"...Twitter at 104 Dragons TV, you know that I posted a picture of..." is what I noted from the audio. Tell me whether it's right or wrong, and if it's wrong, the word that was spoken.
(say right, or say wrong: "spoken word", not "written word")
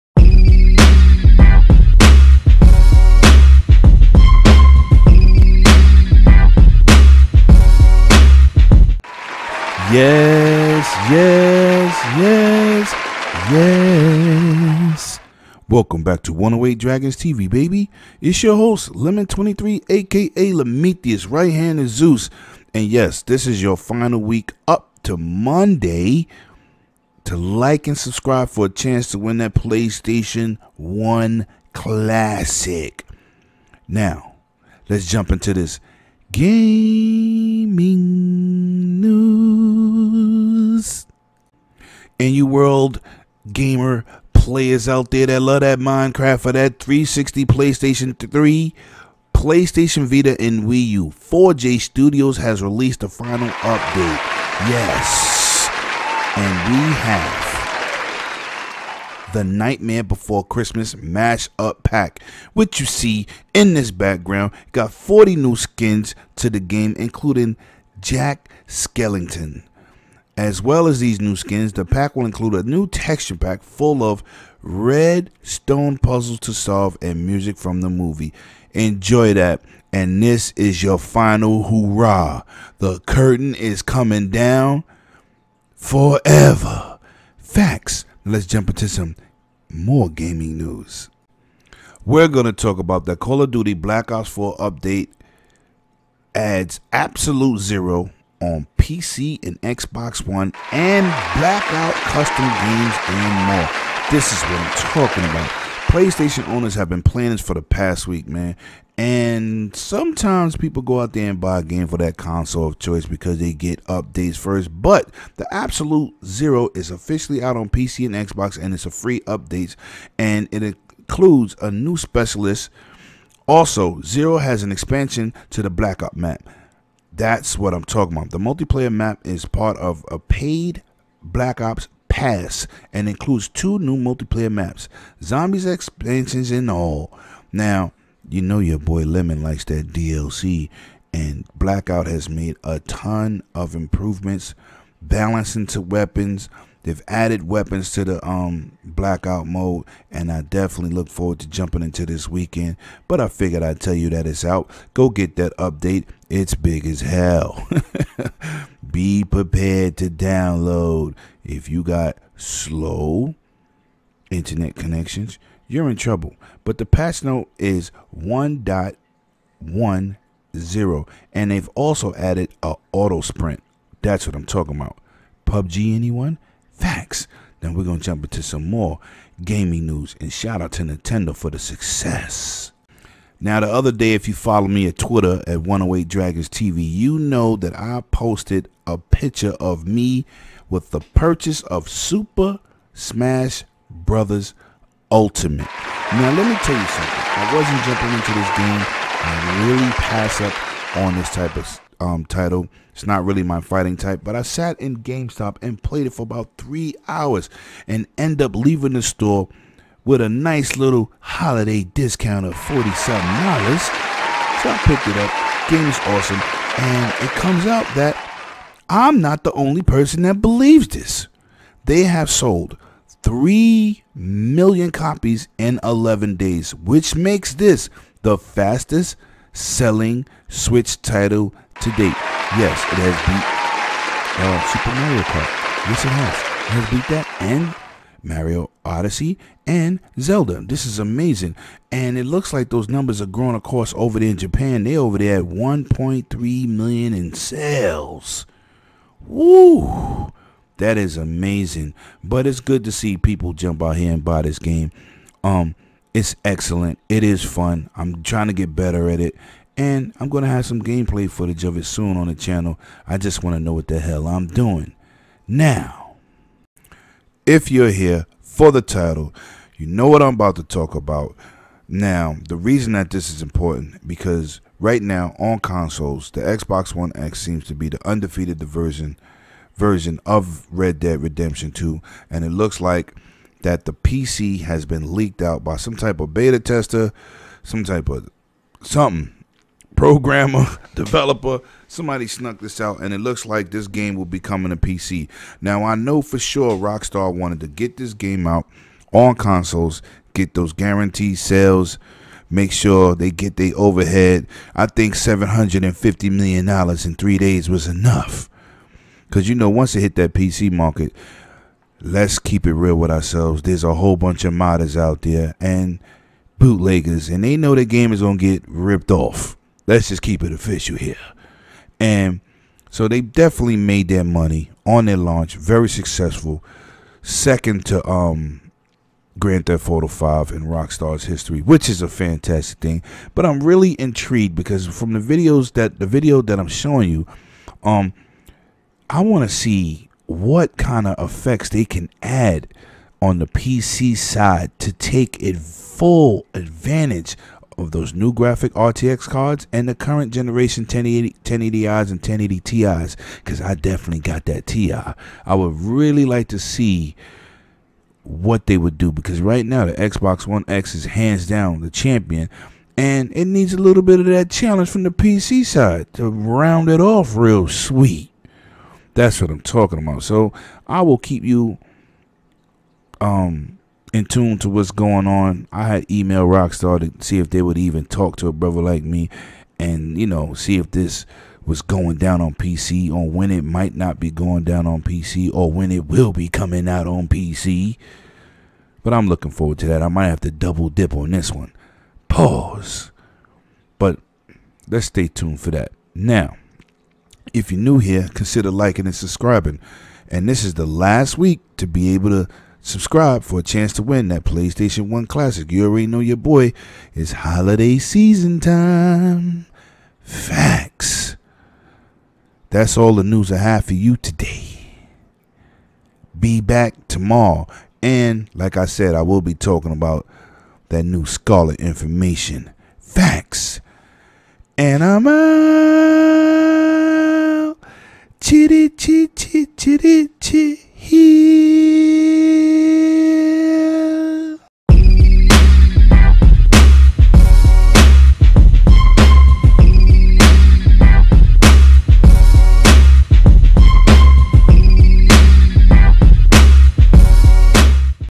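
wrong: "108", not "104".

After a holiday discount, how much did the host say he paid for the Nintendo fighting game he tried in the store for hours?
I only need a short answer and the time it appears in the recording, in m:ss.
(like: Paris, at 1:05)
$47, at 3:32.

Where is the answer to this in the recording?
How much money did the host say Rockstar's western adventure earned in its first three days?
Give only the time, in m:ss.
5:05.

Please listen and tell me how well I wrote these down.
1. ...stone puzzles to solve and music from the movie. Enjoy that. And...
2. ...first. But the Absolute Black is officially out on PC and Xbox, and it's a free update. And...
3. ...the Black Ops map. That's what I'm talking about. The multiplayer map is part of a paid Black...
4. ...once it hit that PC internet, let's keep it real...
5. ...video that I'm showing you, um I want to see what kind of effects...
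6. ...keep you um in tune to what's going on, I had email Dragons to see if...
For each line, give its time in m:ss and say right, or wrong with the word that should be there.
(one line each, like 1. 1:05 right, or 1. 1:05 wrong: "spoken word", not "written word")
1. 1:15 right
2. 1:54 wrong: "Zero", not "Black"
3. 2:05 right
4. 5:09 wrong: "market", not "internet"
5. 5:36 right
6. 6:11 wrong: "Rockstar", not "Dragons".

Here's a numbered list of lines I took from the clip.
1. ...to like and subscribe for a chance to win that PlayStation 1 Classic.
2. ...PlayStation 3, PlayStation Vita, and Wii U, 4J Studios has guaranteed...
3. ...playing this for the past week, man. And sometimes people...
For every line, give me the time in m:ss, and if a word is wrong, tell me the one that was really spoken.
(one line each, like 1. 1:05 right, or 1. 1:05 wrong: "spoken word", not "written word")
1. 0:27 right
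2. 0:47 wrong: "released", not "guaranteed"
3. 1:47 right.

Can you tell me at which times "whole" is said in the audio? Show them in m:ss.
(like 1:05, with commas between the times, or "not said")
5:13.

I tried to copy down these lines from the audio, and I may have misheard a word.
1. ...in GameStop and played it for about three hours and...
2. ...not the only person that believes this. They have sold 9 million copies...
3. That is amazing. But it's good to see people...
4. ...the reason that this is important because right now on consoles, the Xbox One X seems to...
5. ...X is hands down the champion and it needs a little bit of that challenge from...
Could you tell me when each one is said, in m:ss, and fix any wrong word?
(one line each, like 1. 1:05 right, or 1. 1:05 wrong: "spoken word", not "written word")
1. 3:24 right
2. 3:39 wrong: "3", not "9"
3. 4:10 right
4. 4:32 right
5. 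6:00 right.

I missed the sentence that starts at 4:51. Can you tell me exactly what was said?
Somebody snuck this out, and it looks like this game will be coming to PC.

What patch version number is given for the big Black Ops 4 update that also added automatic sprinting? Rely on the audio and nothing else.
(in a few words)
1.10.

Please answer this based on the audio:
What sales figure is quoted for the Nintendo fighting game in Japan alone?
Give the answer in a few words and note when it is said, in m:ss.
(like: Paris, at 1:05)
1.3 million, at 4:05.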